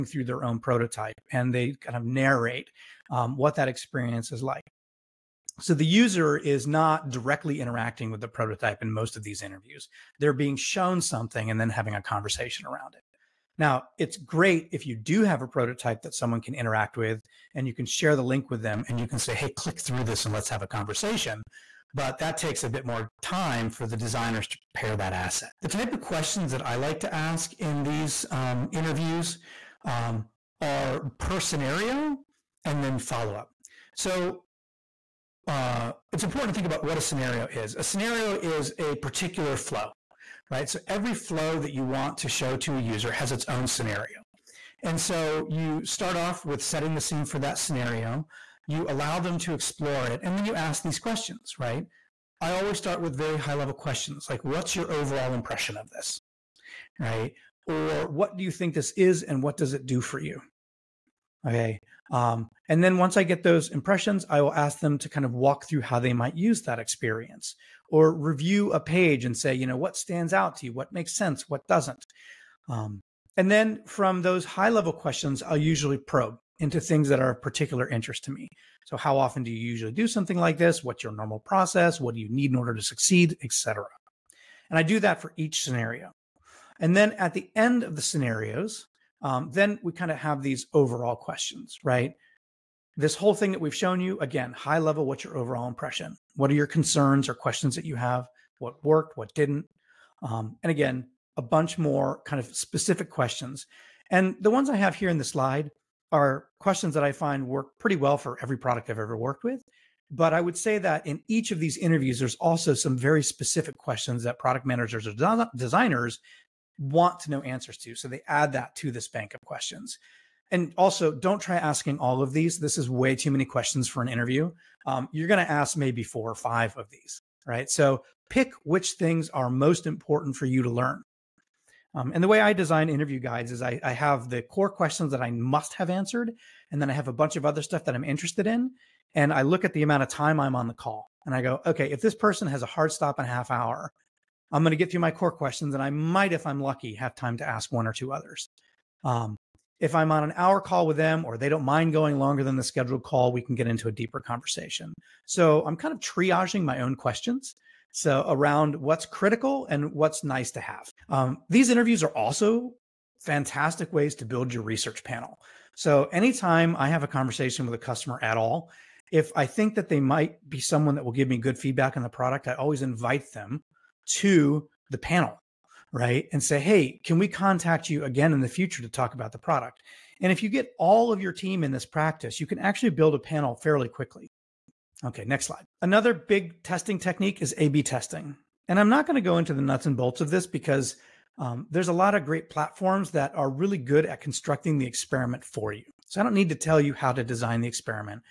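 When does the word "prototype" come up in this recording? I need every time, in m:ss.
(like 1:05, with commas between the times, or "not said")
0:00, 0:08, 0:15.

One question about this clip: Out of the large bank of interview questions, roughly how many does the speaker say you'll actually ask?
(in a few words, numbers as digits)
4 or 5.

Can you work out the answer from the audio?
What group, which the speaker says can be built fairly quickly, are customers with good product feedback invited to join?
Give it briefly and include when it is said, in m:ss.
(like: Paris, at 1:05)
Research panel, at 2:44.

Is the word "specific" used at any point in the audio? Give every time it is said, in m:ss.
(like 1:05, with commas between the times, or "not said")
1:42, 1:53.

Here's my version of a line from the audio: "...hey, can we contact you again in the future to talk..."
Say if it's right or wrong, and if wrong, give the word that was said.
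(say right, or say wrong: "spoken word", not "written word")
right.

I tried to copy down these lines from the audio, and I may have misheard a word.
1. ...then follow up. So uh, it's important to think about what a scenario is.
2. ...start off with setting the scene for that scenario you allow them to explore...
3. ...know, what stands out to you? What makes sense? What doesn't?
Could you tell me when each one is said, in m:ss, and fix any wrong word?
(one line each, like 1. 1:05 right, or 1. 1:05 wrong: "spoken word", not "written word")
1. 0:32 right
2. 0:45 right
3. 1:09 right.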